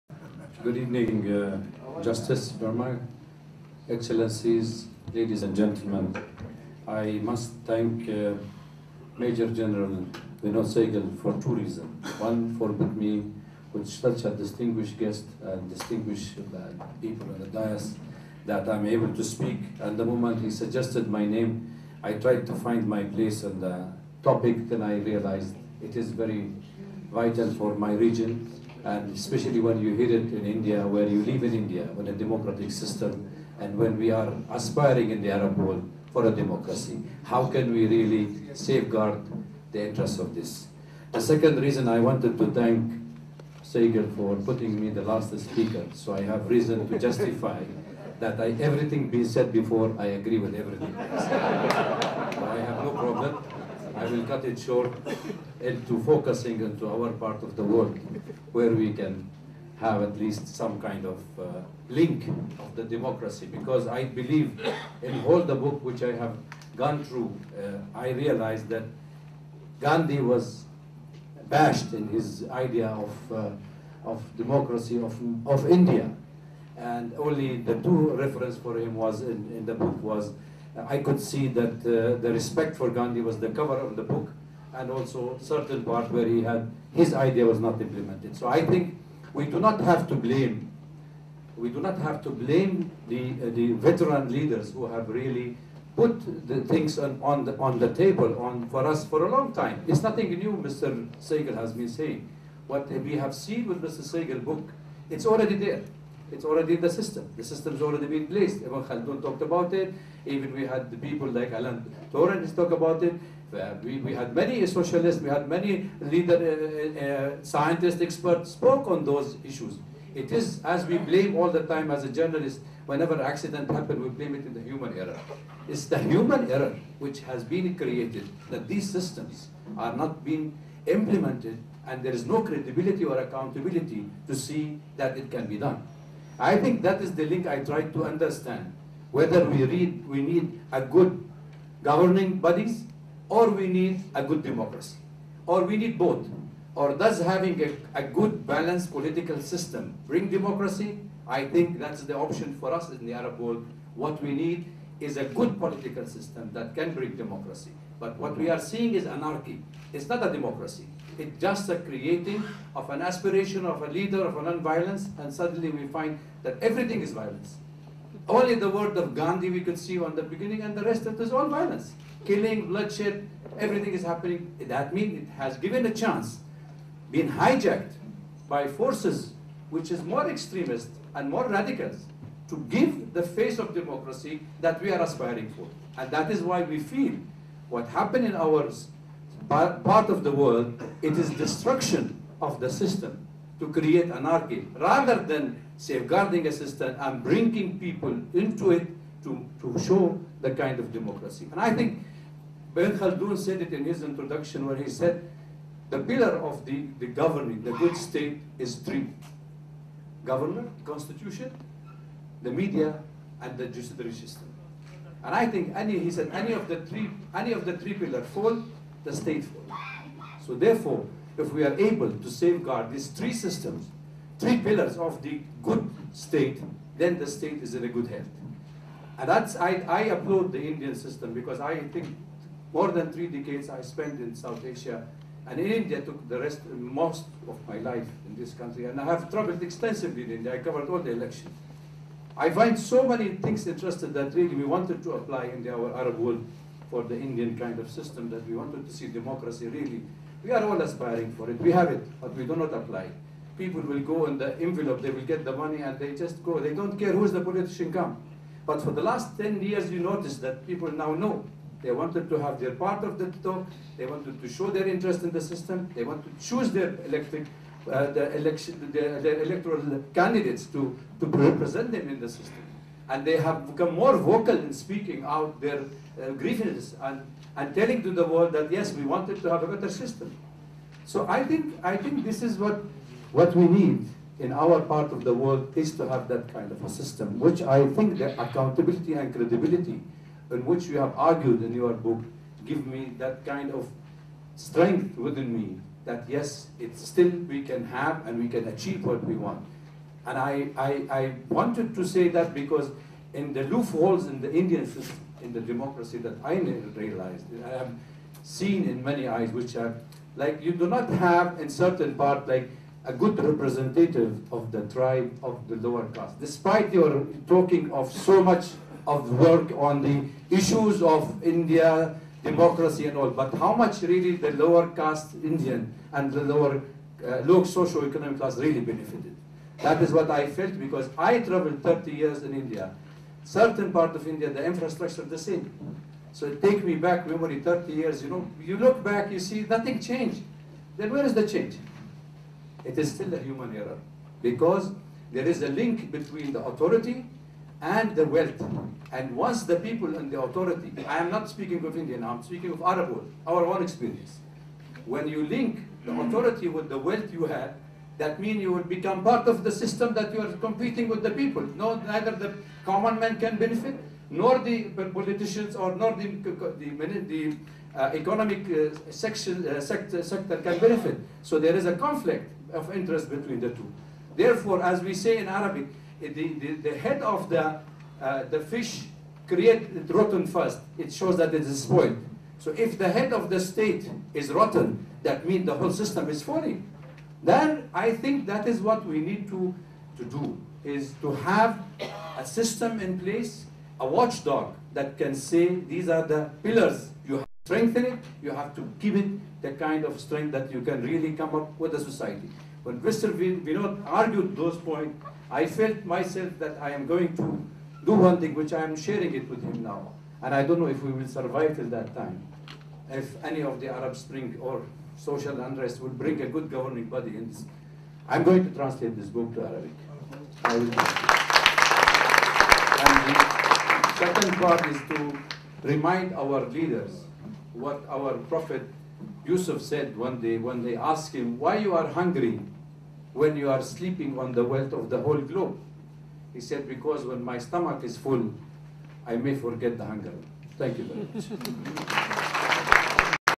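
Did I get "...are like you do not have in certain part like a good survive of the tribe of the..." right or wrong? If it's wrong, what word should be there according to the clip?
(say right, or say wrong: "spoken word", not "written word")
wrong: "representative", not "survive".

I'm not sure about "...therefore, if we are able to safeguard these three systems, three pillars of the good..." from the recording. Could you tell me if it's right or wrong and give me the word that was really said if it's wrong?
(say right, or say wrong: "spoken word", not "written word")
right.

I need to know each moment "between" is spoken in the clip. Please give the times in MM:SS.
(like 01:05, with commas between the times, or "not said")
05:46, 06:13.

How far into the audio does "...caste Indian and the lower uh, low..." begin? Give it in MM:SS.
05:24.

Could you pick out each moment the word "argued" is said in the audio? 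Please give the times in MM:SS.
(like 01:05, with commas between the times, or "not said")
04:51, 06:44.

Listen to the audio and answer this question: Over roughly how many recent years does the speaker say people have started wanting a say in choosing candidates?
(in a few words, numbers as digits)
10 years.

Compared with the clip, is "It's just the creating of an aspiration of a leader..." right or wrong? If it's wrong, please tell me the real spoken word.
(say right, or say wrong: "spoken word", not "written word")
right.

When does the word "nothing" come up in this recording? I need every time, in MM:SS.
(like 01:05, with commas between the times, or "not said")
01:40, 05:39.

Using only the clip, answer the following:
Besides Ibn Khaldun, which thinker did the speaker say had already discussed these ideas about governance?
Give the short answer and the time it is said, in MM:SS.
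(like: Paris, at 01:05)
Alain Touraine, at 01:51.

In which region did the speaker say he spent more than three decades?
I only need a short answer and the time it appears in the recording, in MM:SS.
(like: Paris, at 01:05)
South Asia, at 03:54.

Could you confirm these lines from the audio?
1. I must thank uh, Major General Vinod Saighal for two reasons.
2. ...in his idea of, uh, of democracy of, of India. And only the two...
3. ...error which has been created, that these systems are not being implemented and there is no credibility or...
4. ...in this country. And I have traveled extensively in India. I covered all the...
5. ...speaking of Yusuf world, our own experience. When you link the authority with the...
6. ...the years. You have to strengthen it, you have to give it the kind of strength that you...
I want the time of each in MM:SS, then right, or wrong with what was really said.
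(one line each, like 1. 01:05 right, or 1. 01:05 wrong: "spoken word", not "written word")
1. 00:06 right
2. 01:11 right
3. 02:06 right
4. 03:58 right
5. 05:52 wrong: "Arab", not "Yusuf"
6. 06:36 wrong: "pillars", not "years".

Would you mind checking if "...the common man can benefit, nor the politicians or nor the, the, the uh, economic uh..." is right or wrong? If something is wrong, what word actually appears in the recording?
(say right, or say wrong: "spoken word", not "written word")
right.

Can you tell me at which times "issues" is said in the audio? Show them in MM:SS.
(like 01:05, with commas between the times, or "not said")
01:59, 05:20.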